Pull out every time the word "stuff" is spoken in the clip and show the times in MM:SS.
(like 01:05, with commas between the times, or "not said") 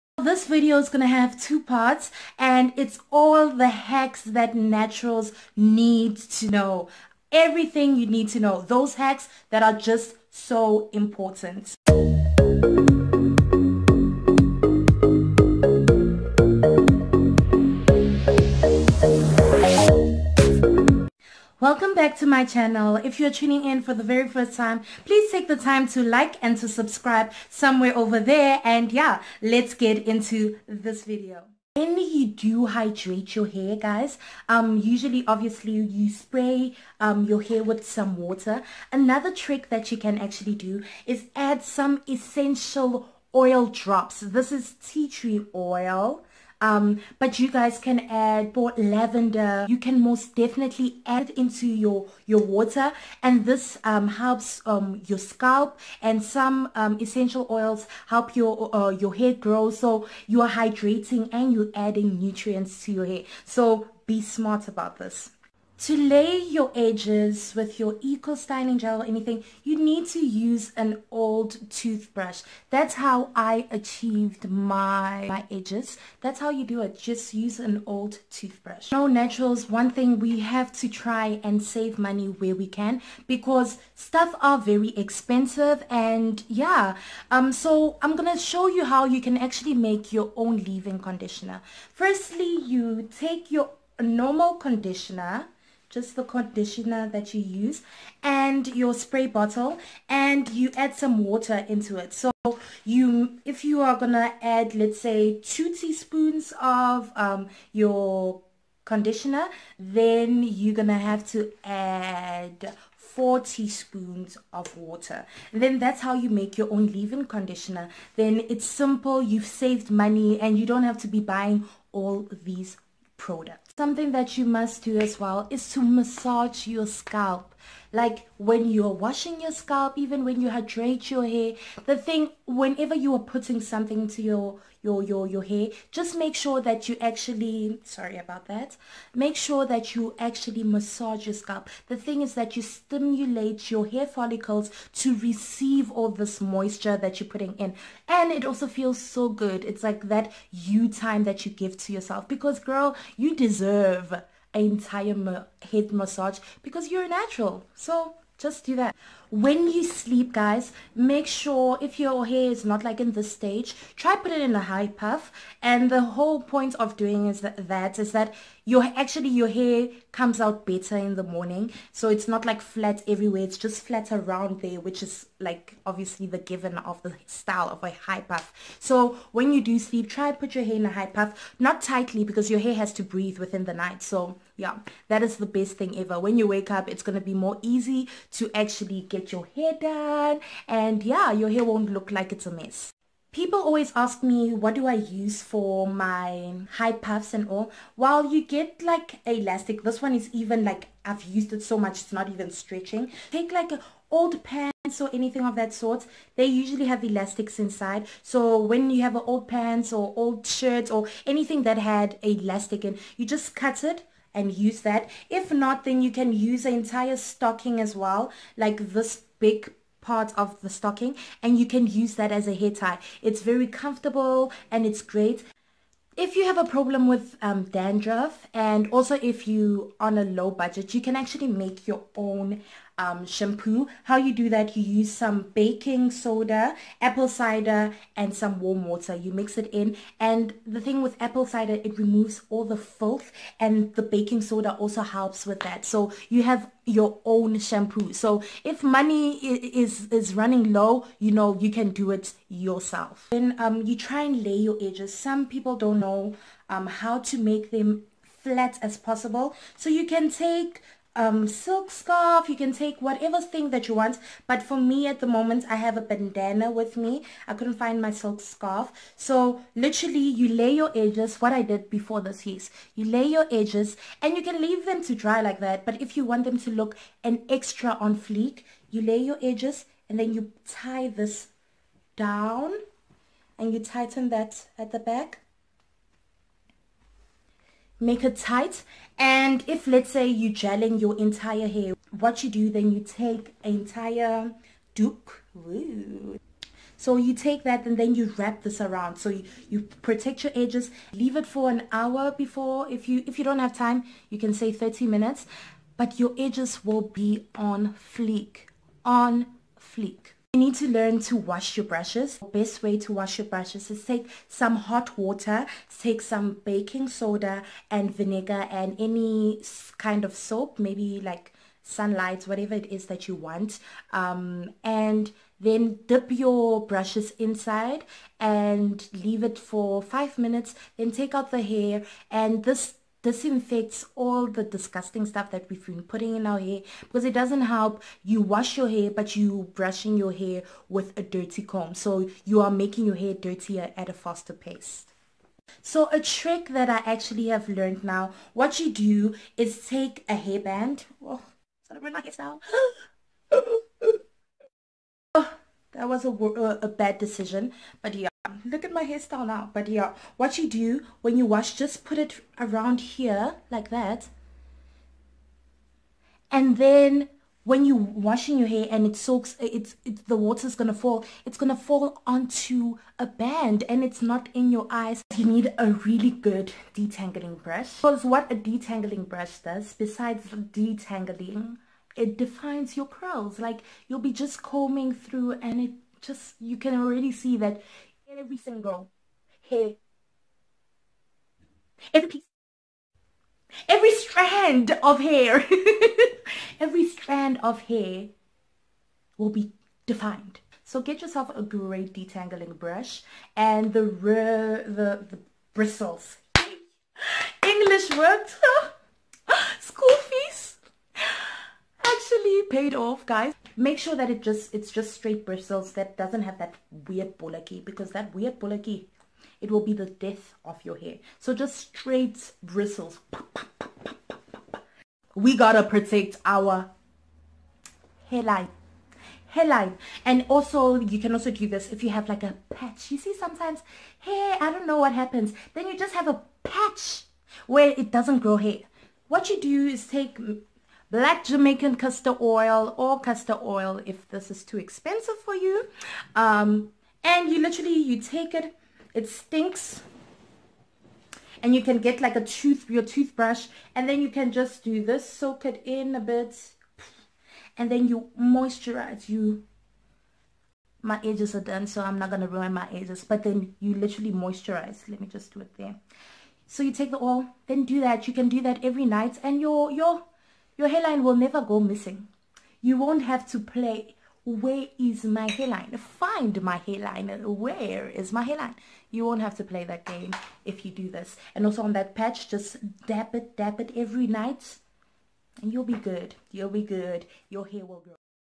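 01:23, 05:35.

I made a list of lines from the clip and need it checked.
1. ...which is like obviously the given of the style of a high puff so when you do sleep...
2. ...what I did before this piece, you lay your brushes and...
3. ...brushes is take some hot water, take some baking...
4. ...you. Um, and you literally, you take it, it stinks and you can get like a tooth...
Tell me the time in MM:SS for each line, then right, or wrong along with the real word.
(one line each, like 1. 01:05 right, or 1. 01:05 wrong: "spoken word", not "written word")
1. 02:54 right
2. 04:31 wrong: "edges", not "brushes"
3. 05:13 right
4. 07:25 right.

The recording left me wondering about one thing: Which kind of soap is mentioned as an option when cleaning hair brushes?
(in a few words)
Sunlight.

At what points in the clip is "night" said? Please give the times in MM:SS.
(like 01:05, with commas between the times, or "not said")
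03:03, 07:49, 08:04.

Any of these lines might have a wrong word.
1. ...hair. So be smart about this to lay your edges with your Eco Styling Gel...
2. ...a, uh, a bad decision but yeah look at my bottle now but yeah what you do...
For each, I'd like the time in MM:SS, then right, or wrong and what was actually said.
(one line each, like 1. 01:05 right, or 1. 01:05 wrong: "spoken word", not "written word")
1. 01:03 right
2. 05:56 wrong: "hairstyle", not "bottle".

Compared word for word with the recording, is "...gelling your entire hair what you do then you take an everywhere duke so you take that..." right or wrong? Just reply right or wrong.
wrong.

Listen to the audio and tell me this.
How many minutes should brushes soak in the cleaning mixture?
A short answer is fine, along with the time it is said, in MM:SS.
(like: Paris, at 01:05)
5, at 05:30.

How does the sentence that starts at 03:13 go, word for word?
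People always ask me what do I use for my high puffs and all.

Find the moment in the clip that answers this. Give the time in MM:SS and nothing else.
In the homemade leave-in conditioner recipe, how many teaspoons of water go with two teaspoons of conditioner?
01:52.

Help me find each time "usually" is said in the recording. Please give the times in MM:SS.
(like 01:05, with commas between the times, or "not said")
00:34, 03:26.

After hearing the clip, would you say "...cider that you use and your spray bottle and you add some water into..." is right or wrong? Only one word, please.
wrong.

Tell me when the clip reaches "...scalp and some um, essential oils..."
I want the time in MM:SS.
00:55.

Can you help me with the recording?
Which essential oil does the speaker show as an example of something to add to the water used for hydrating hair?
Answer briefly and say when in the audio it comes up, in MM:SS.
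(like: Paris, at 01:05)
Tea tree oil, at 00:44.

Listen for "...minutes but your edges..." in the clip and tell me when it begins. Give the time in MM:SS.
05:05.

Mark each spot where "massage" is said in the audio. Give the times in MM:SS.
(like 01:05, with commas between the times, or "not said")
02:05, 02:20, 02:35.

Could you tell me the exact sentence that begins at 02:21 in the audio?
The thing is that you stimulate your hair follicles to receive all this moisture that you're putting in.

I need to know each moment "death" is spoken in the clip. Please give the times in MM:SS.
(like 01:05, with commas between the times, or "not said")
07:00.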